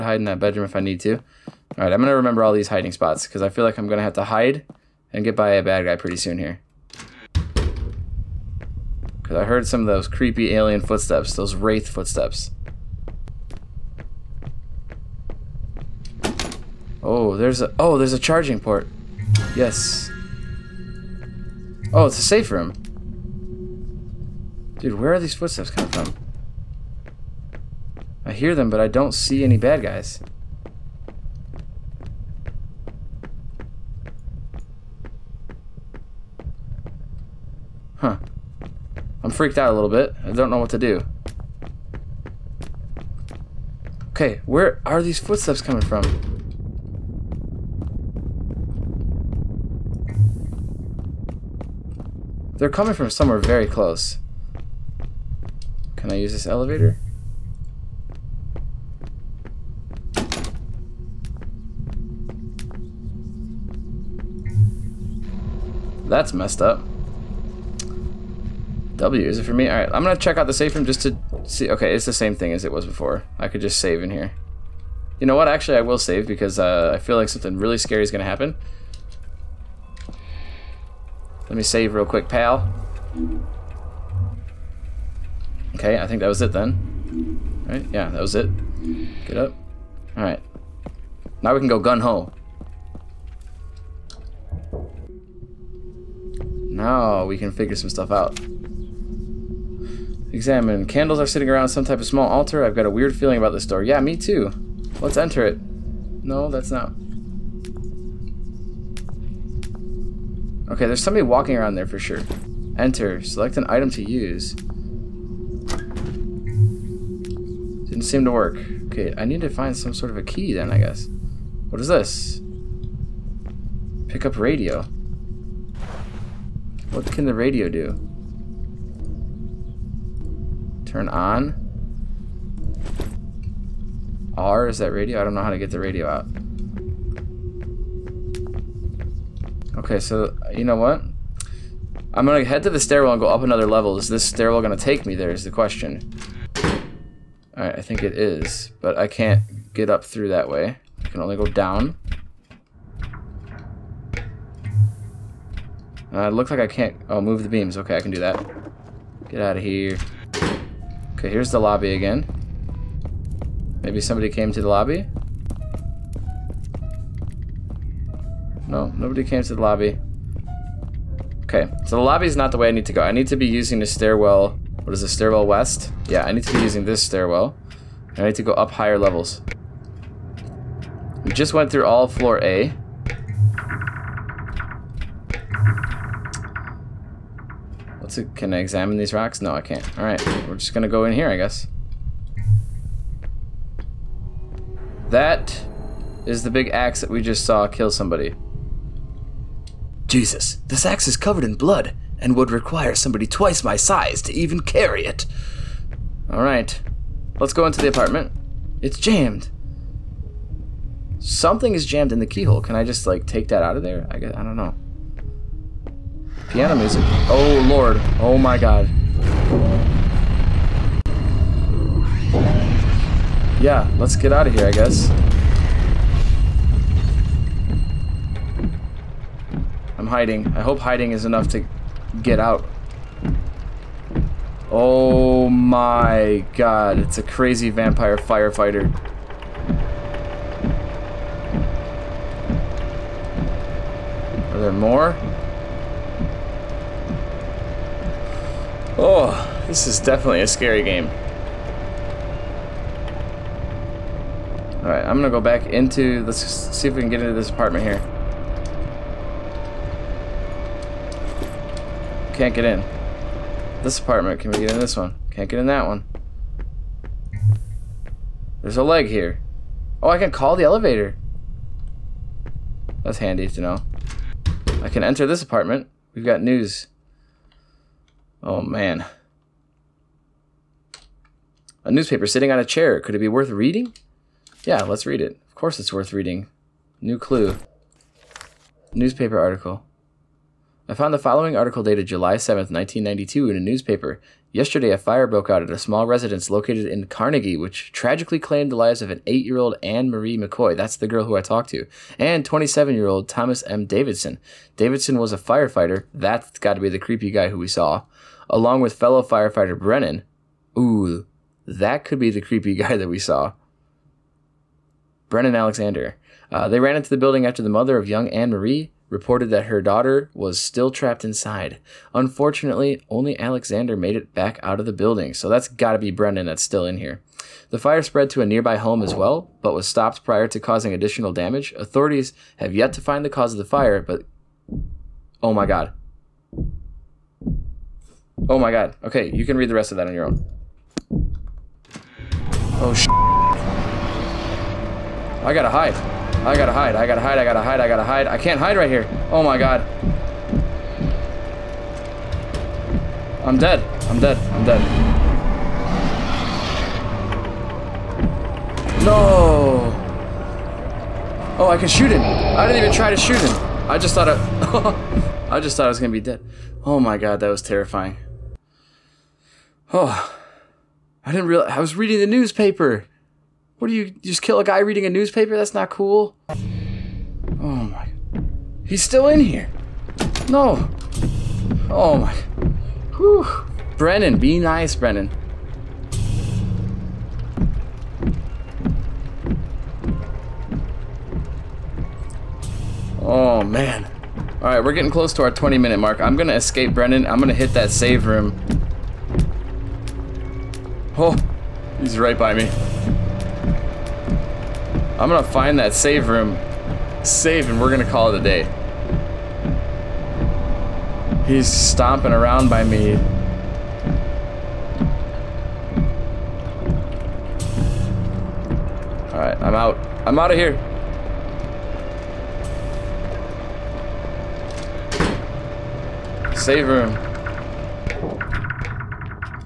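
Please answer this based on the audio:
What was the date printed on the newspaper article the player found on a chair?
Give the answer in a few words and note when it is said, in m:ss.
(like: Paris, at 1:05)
July 7, 1992, at 4:52.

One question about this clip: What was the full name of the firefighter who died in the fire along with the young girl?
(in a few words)
Thomas M. Davidson.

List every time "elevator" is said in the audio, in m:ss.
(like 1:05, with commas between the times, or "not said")
0:56, 4:30.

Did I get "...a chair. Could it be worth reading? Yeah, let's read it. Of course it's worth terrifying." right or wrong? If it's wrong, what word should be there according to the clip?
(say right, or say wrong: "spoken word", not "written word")
wrong: "reading", not "terrifying".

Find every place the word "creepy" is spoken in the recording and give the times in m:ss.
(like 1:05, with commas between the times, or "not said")
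0:10, 5:06, 5:12.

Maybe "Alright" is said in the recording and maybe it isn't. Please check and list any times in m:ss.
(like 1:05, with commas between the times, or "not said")
1:09, 1:30, 2:27, 3:09, 4:14, 6:59.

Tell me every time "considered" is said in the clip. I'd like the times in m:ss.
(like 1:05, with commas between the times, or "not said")
not said.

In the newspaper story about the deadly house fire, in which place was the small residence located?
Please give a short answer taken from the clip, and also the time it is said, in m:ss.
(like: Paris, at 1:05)
Carnegie, at 4:57.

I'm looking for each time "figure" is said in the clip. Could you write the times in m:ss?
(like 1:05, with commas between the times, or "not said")
1:37.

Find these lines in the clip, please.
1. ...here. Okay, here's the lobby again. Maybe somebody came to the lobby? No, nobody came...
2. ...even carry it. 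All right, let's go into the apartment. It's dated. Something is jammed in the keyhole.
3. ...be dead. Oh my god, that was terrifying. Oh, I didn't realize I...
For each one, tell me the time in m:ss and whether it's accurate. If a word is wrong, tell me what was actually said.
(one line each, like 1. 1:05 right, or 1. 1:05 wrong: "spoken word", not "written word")
1. 2:39 right
2. 3:24 wrong: "jammed", not "dated"
3. 6:06 right.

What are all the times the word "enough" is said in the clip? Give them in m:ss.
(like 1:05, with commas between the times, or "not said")
3:51.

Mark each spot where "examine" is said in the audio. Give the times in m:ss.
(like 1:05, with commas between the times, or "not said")
1:40, 3:08.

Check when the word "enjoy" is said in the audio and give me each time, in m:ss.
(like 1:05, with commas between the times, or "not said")
not said.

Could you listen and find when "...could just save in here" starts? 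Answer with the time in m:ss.
1:13.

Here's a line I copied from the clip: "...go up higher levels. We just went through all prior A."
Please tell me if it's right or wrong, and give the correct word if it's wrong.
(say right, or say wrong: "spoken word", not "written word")
wrong: "floor", not "prior".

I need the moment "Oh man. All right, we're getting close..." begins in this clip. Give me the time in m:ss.
6:33.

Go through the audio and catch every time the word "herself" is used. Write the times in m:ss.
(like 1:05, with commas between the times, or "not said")
not said.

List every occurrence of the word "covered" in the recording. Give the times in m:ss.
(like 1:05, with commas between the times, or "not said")
3:21.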